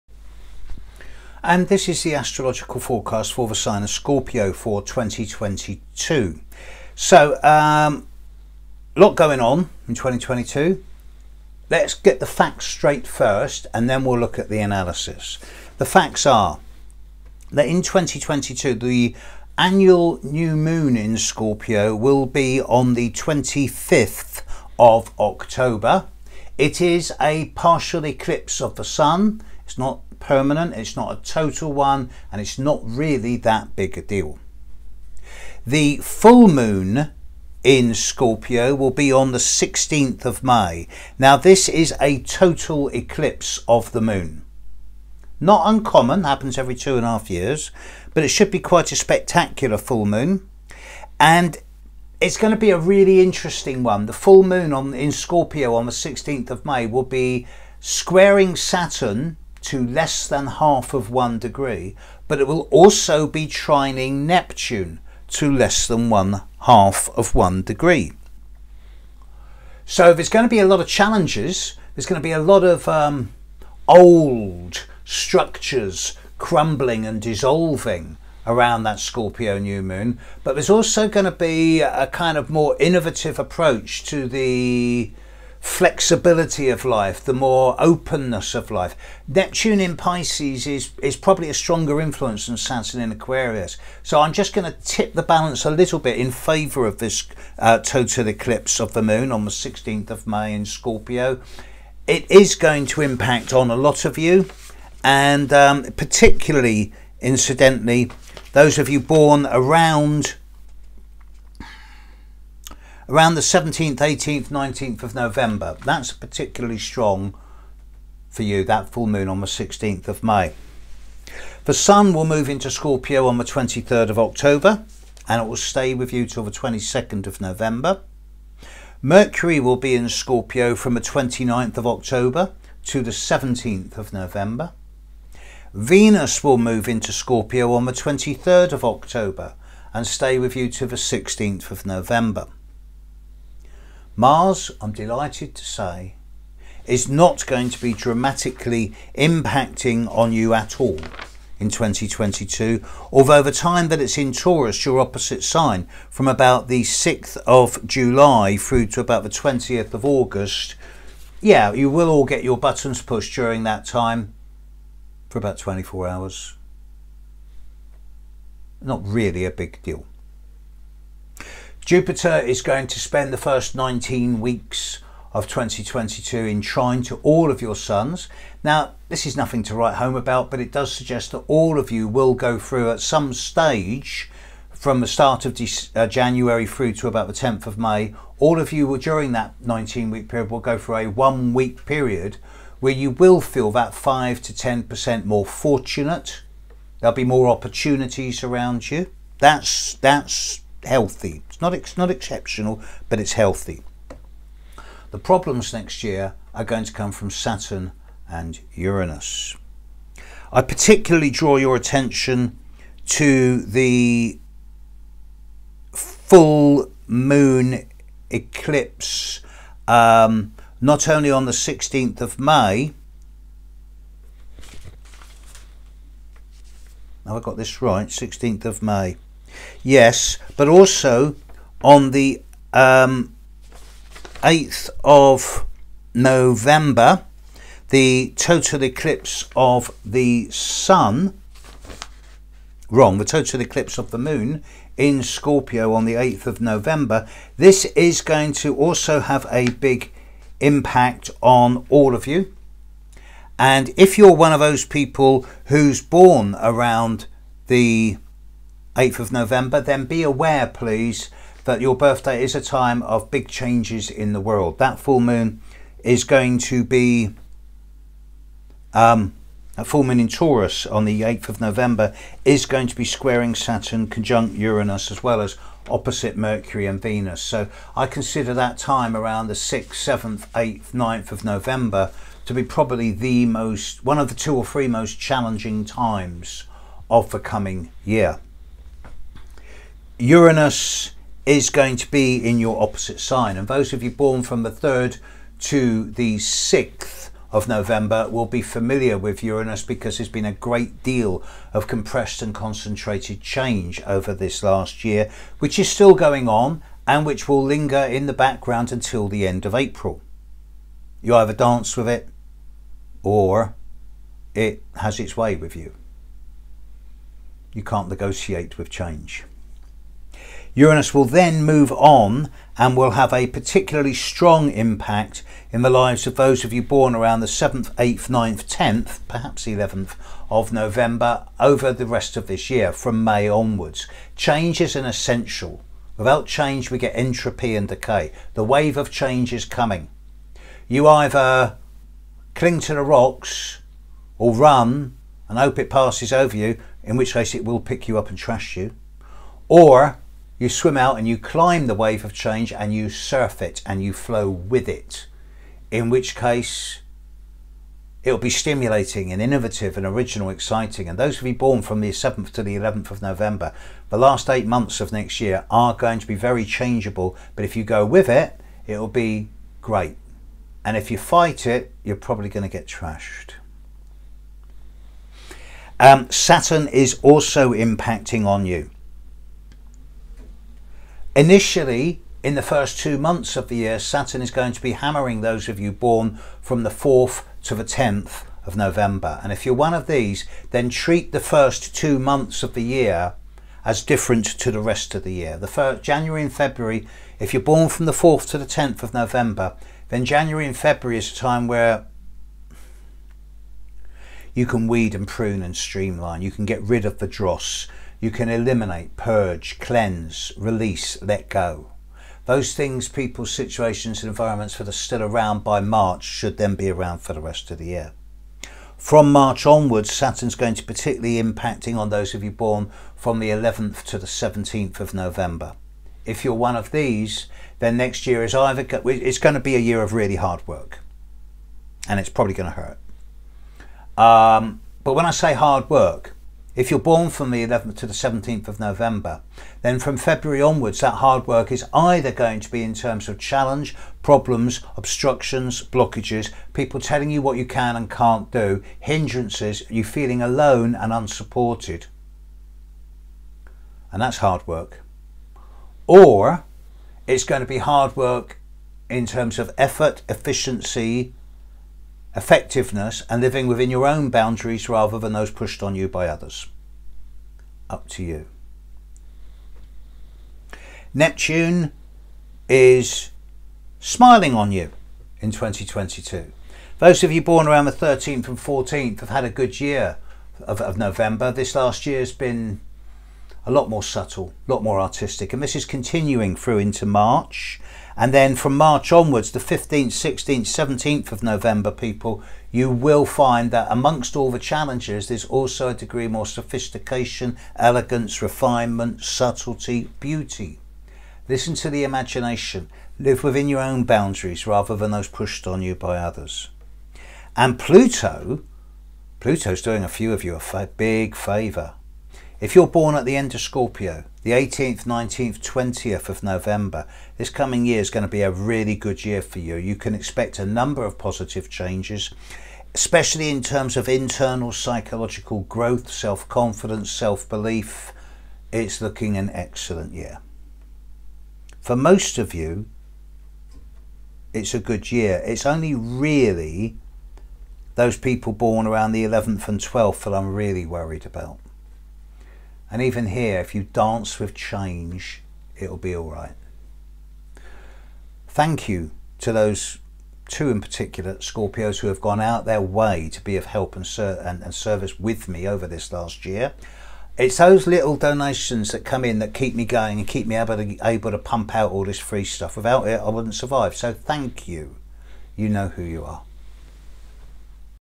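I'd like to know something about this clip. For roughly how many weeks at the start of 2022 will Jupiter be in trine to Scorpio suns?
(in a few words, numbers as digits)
19.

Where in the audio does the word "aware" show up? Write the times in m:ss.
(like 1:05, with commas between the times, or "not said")
4:20.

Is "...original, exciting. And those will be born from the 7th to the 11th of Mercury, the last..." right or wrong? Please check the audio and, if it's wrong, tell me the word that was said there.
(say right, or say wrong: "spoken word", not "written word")
wrong: "November", not "Mercury".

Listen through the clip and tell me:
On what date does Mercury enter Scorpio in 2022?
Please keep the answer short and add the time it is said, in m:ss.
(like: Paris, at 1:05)
29th of October, at 2:11.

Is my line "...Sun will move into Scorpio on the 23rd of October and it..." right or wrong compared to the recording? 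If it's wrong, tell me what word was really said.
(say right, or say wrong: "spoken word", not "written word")
right.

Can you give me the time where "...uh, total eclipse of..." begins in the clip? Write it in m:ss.
1:37.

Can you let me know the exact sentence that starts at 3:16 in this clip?
There'll be more opportunities around you.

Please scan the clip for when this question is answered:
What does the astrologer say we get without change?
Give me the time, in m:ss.
5:37.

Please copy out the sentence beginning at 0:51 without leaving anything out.
And it's going to be a really interesting one.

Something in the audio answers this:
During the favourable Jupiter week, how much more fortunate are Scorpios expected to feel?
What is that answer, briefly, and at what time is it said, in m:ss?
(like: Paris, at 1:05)
5 to 10%, at 3:13.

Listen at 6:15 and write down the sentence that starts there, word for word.
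Um, Saturn is also impacting on you.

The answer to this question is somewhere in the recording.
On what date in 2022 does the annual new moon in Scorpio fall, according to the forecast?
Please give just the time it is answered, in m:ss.
0:23.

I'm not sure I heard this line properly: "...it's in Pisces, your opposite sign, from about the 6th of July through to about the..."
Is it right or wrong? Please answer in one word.
wrong.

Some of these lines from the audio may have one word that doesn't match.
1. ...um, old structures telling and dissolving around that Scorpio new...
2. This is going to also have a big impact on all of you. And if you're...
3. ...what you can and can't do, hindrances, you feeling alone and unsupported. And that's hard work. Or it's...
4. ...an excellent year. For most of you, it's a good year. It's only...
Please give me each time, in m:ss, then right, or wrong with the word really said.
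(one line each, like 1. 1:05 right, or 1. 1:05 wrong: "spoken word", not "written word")
1. 1:12 wrong: "crumbling", not "telling"
2. 4:07 right
3. 7:27 right
4. 8:49 right.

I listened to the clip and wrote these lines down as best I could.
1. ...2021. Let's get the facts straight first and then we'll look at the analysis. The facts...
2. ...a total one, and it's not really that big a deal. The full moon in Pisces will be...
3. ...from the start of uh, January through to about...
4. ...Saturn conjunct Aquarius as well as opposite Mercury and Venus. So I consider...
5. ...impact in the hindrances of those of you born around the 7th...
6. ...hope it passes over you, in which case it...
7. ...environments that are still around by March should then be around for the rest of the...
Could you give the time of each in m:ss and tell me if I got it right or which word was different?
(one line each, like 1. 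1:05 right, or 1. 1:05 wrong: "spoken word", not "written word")
1. 0:09 wrong: "2022", not "2021"
2. 0:31 wrong: "Scorpio", not "Pisces"
3. 3:04 right
4. 4:33 wrong: "Uranus", not "Aquarius"
5. 5:24 wrong: "lives", not "hindrances"
6. 5:45 right
7. 6:54 right.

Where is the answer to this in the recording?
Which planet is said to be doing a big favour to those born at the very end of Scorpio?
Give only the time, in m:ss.
8:29.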